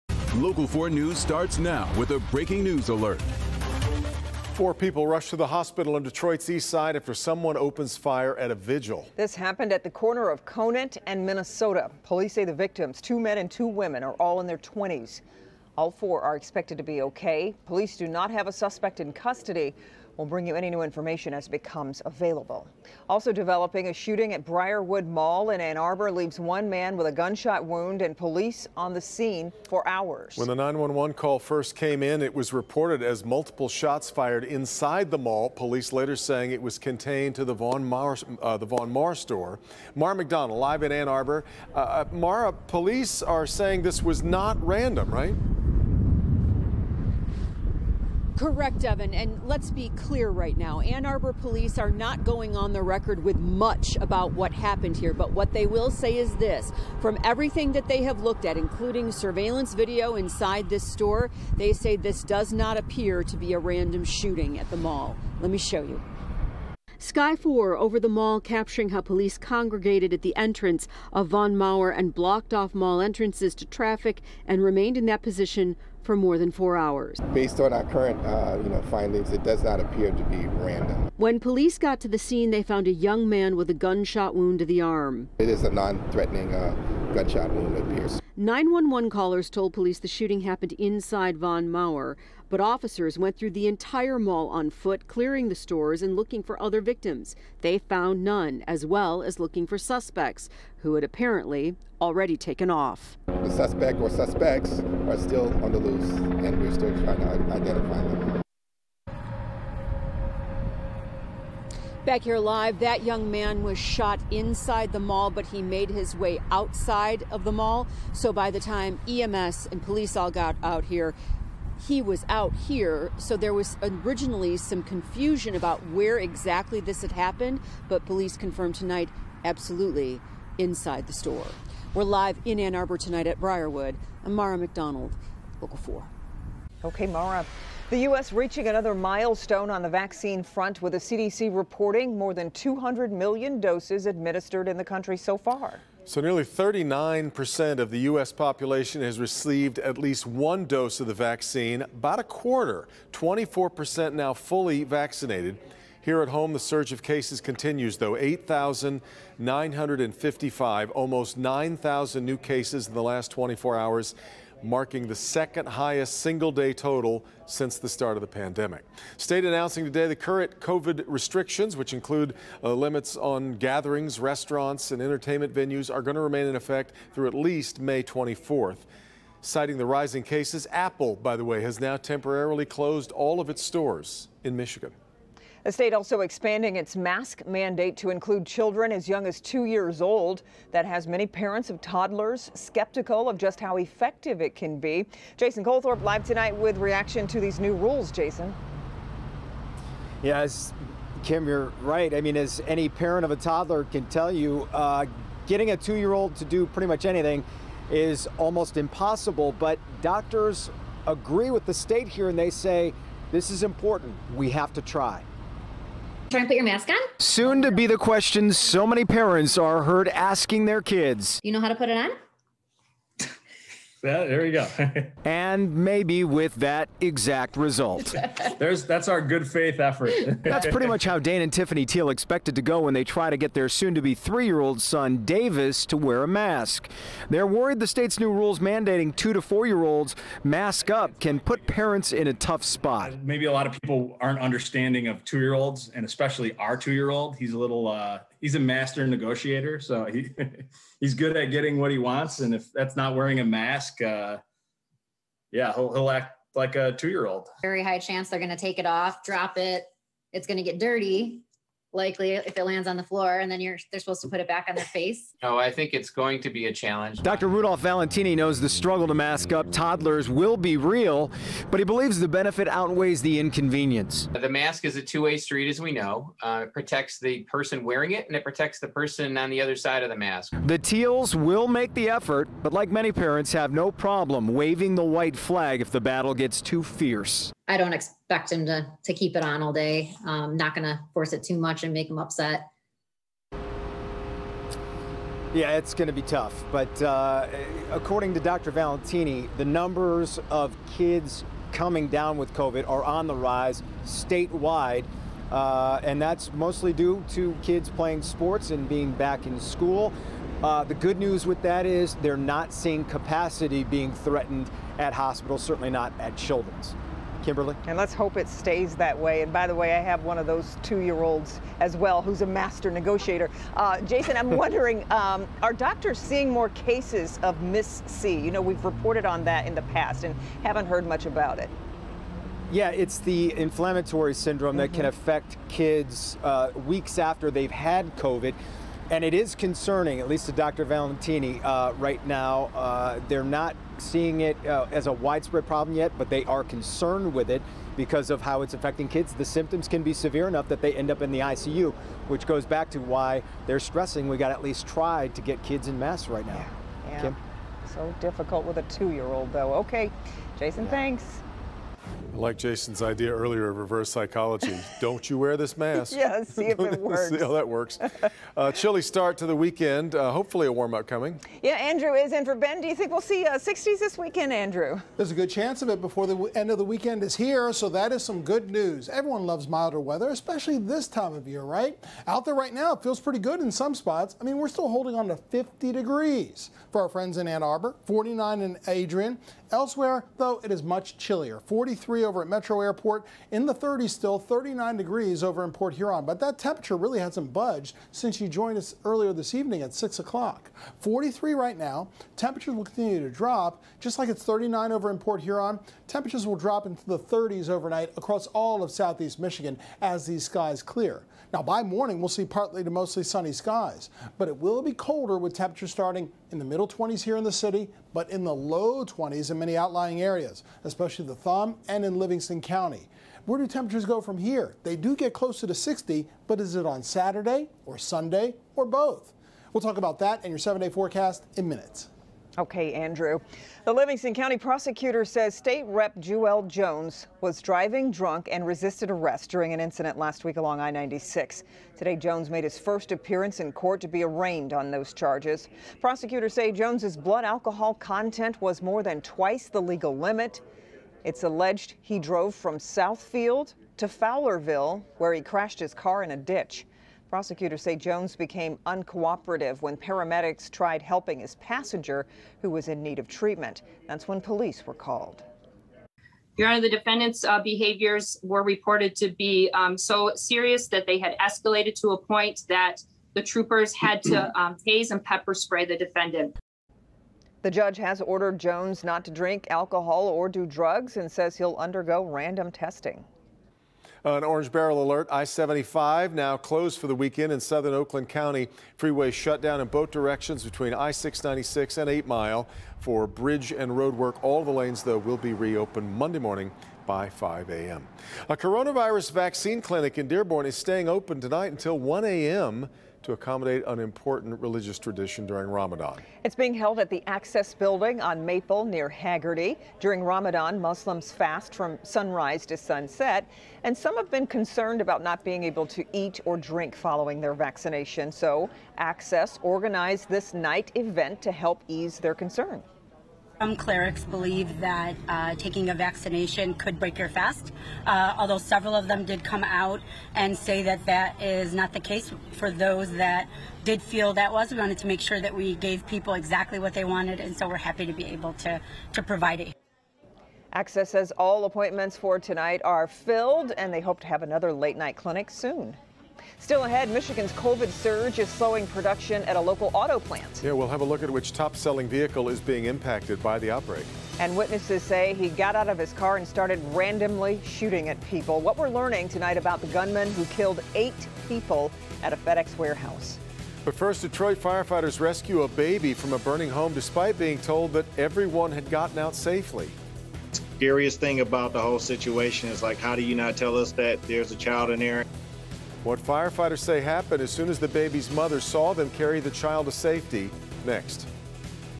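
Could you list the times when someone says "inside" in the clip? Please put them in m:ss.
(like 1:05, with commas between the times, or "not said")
0:34, 1:00, 1:30, 1:54, 2:10.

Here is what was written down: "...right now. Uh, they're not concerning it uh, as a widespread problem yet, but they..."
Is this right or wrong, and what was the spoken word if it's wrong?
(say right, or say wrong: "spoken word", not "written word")
wrong: "seeing", not "concerning".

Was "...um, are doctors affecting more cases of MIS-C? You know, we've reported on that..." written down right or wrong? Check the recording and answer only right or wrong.
wrong.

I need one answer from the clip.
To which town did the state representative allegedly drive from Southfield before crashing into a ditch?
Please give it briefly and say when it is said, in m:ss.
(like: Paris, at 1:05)
Fowlerville, at 7:34.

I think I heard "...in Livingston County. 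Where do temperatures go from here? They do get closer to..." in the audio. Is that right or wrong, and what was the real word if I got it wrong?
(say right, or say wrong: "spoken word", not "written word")
right.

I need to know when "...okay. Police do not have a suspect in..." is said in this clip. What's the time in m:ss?
0:17.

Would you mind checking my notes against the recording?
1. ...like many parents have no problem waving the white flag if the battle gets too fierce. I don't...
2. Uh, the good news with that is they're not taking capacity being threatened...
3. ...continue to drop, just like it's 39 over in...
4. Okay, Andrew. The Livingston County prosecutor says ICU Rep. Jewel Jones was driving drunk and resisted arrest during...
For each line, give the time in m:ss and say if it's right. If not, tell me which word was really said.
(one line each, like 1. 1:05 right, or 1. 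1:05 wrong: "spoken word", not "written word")
1. 4:42 right
2. 5:10 wrong: "seeing", not "taking"
3. 6:42 right
4. 7:12 wrong: "State", not "ICU".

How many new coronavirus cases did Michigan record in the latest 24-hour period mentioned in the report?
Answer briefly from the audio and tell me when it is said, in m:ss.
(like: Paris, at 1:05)
8,955, at 2:38.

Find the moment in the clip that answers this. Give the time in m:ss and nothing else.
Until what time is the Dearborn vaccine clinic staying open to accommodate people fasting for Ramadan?
8:21.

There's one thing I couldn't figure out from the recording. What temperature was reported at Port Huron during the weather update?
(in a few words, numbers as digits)
39 degrees.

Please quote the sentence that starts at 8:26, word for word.
It's being held at the Access Building on Maple near Haggerty.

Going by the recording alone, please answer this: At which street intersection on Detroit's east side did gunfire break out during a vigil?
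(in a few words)
Conant and Minnesota.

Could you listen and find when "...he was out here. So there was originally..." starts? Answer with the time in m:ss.
2:01.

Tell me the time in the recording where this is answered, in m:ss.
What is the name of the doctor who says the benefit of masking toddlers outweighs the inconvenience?
4:27.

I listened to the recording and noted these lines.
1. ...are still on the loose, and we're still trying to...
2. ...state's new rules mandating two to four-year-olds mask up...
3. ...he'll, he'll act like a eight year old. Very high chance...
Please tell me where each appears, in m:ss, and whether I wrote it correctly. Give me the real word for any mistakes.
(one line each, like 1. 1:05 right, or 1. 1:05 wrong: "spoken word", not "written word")
1. 1:45 right
2. 3:57 right
3. 4:15 wrong: "two", not "eight".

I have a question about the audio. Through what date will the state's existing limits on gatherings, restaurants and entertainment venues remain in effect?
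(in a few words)
May 24th.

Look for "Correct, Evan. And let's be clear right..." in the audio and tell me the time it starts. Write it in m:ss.
0:48.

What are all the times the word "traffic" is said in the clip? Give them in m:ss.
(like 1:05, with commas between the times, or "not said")
1:13.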